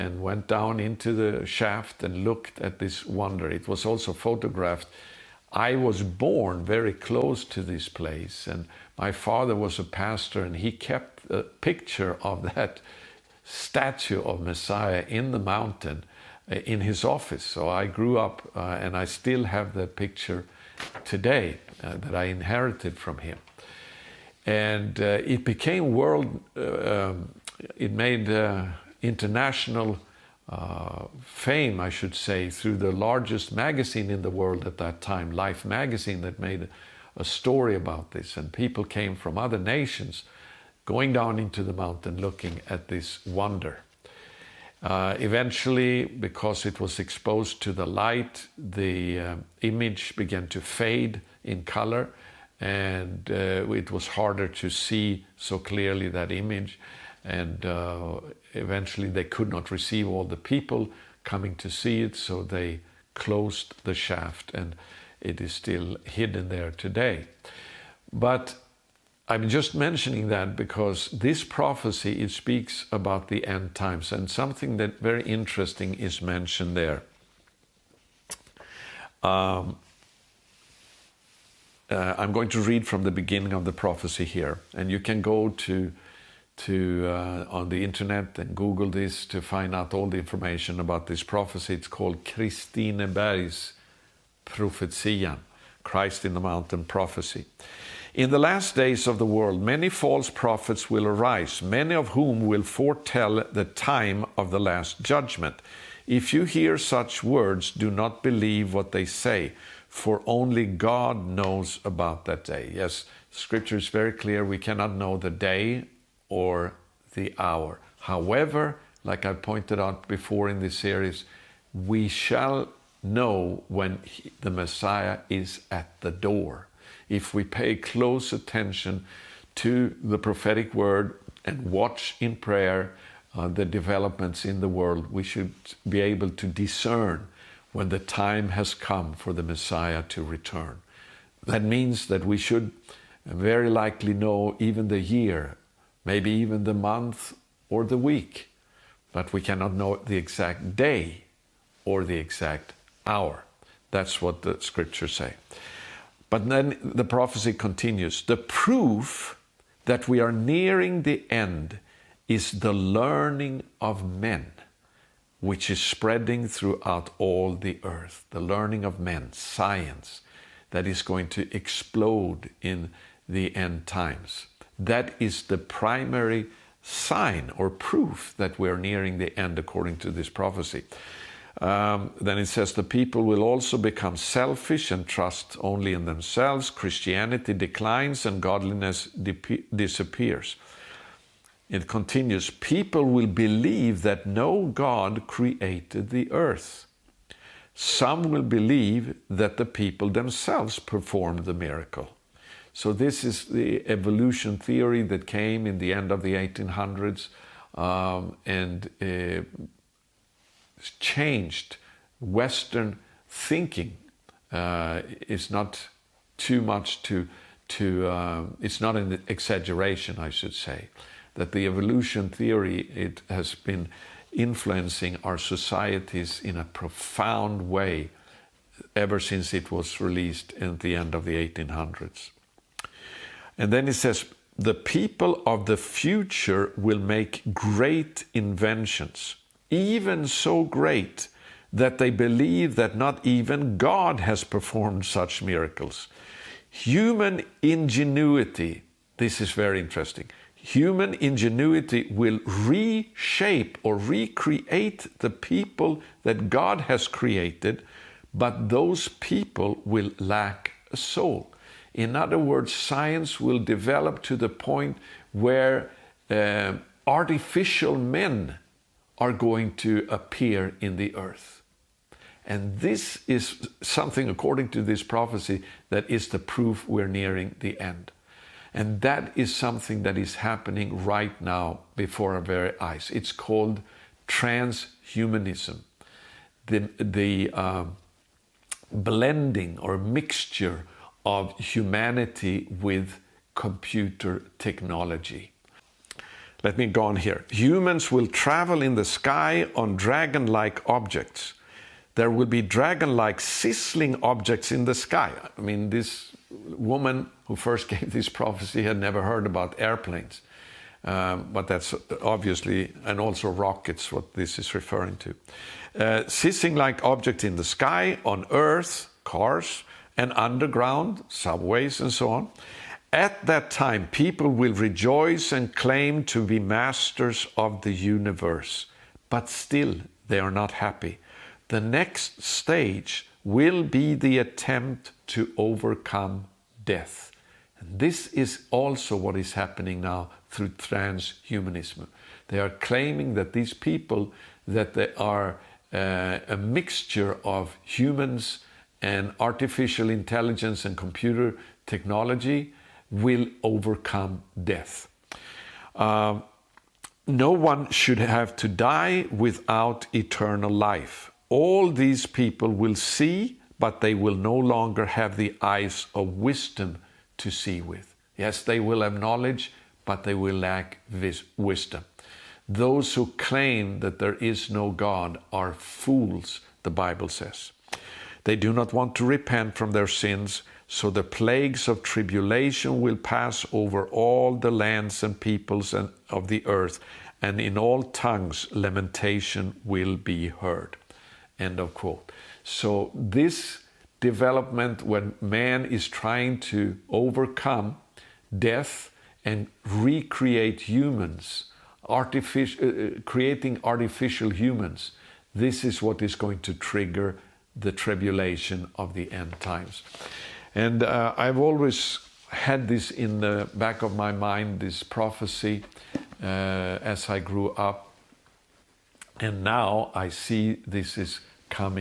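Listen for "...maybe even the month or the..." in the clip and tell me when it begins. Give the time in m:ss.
2:26.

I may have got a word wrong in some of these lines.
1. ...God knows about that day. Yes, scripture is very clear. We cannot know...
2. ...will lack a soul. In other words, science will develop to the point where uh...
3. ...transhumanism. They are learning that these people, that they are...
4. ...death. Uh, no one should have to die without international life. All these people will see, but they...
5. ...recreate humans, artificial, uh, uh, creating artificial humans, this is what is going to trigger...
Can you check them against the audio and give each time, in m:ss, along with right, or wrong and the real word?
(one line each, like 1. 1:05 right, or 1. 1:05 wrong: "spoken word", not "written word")
1. 1:50 right
2. 4:19 right
3. 5:40 wrong: "claiming", not "learning"
4. 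5:54 wrong: "eternal", not "international"
5. 6:39 right.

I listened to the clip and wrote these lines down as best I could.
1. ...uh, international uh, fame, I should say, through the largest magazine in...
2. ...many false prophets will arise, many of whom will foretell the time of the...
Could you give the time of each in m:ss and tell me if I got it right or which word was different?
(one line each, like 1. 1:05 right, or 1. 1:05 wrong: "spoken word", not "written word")
1. 0:28 right
2. 1:39 right.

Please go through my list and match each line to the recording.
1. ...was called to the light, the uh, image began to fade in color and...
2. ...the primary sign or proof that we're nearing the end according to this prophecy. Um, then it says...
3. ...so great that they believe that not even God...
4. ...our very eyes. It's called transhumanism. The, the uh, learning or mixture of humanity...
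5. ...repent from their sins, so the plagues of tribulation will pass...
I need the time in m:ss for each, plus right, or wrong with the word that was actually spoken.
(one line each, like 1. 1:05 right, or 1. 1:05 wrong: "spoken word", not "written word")
1. 0:46 wrong: "exposed", not "called"
2. 2:55 right
3. 4:00 right
4. 4:42 wrong: "blending", not "learning"
5. 6:19 right.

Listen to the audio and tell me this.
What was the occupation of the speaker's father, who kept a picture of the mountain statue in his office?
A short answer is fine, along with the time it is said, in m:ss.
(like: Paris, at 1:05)
Pastor, at 0:09.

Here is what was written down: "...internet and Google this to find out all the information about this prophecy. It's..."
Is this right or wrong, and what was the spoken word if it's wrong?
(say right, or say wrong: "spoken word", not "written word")
right.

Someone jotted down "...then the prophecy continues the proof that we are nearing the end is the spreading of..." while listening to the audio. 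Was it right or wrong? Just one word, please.
wrong.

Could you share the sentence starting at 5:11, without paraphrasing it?
Um, but that's obviously, and also rockets, what this is referring to.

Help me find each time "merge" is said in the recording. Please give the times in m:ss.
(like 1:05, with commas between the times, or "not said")
not said.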